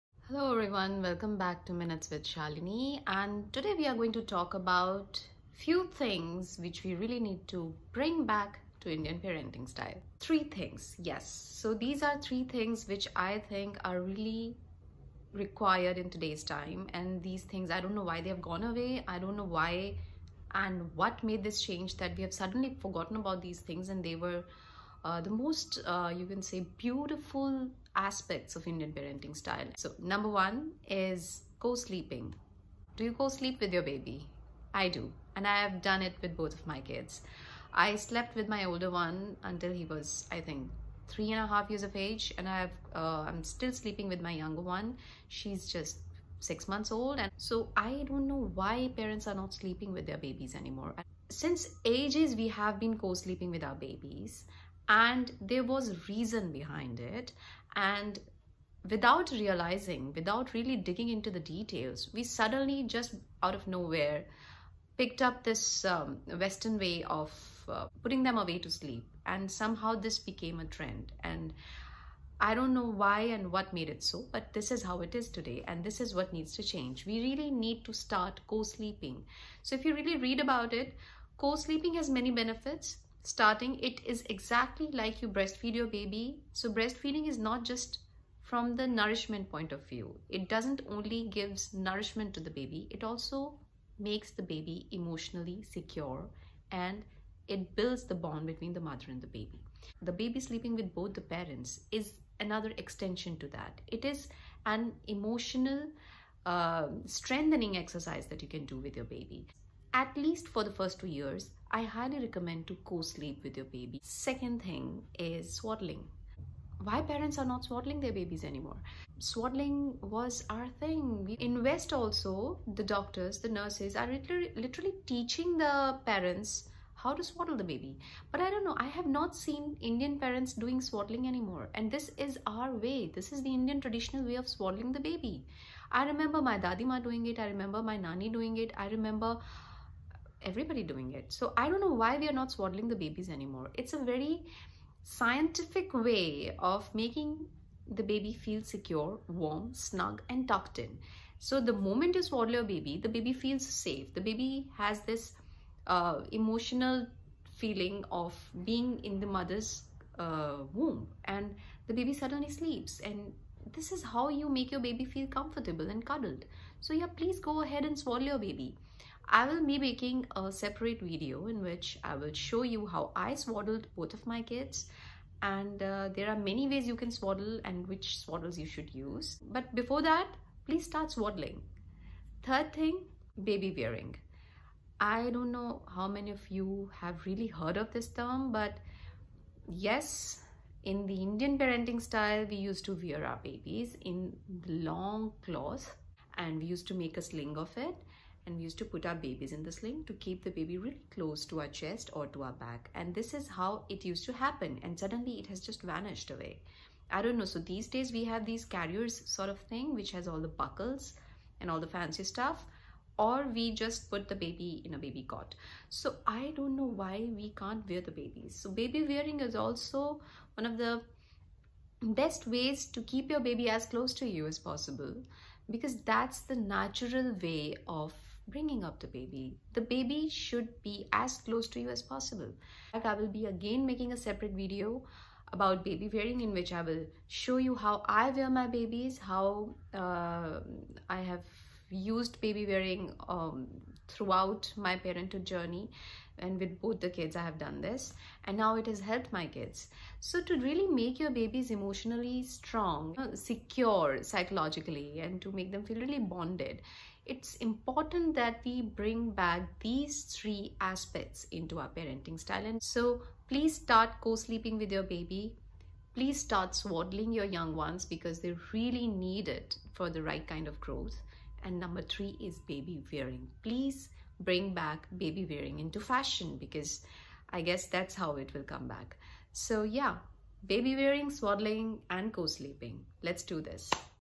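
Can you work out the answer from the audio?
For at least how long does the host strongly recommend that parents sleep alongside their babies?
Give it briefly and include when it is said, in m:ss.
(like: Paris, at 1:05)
first 2 years, at 1:50.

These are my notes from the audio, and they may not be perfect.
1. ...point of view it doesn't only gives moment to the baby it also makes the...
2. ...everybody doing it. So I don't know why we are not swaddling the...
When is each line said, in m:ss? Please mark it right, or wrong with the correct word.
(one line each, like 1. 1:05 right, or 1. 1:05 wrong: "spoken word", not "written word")
1. 1:29 wrong: "nourishment", not "moment"
2. 2:20 right.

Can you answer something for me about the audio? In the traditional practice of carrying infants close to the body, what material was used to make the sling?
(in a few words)
long cloth.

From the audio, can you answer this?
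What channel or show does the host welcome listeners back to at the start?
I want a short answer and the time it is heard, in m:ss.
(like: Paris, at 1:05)
Minutes with Shalini, at 0:01.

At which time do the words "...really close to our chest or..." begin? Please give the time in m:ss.
3:20.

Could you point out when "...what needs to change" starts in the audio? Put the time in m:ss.
1:16.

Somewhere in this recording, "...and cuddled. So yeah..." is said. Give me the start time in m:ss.
2:45.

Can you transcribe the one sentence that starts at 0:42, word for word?
And I've, uh, I'm still sleeping with my younger one.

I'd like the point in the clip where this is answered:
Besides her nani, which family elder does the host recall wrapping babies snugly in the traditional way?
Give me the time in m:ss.
2:16.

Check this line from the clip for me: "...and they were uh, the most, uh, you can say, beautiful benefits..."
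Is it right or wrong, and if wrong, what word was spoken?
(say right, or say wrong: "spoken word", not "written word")
wrong: "aspects", not "benefits".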